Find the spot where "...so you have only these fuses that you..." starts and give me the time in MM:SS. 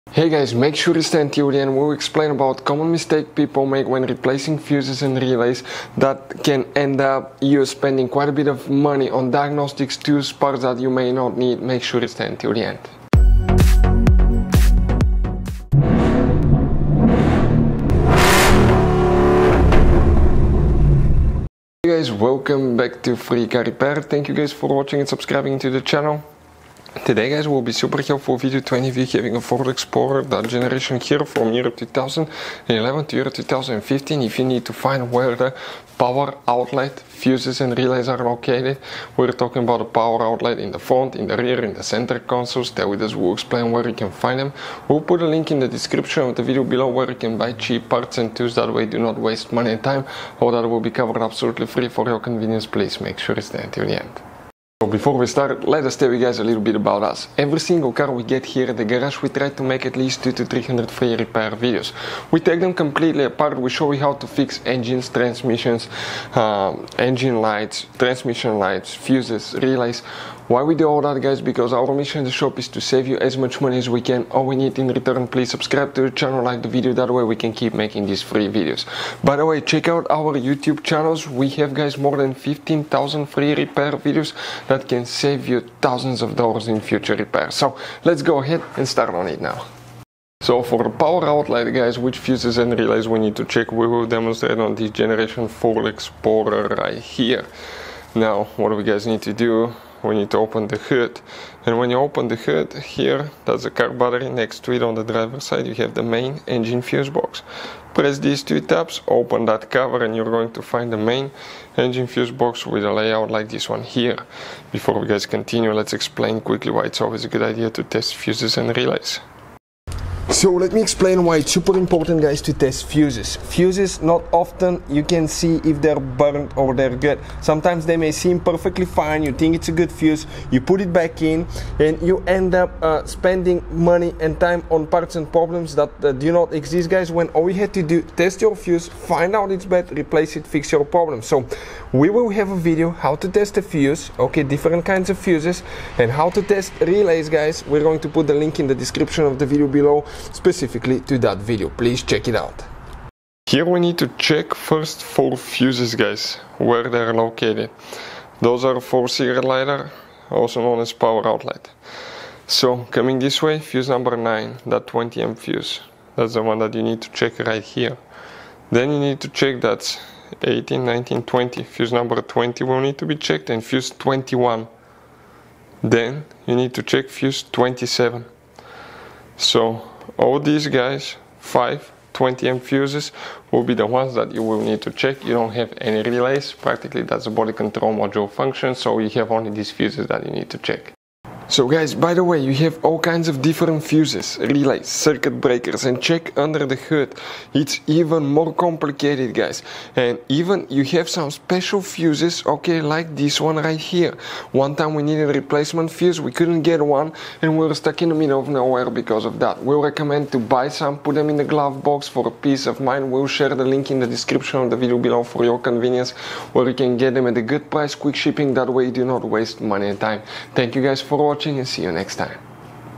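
03:08.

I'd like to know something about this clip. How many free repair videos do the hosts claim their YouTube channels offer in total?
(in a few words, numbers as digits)
more than 15,000.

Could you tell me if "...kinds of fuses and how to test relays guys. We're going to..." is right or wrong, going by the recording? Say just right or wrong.
right.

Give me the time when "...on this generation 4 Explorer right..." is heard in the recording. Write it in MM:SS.
01:34.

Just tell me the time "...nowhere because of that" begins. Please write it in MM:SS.
03:28.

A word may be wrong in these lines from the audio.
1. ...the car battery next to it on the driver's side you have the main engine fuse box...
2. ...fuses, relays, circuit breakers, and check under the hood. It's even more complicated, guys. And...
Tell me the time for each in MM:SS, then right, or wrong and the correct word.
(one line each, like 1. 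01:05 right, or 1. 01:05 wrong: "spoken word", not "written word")
1. 01:43 right
2. 03:13 right.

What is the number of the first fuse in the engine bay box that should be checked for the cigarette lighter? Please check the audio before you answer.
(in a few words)
9.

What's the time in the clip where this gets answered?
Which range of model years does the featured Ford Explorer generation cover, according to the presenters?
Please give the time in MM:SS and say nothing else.
00:31.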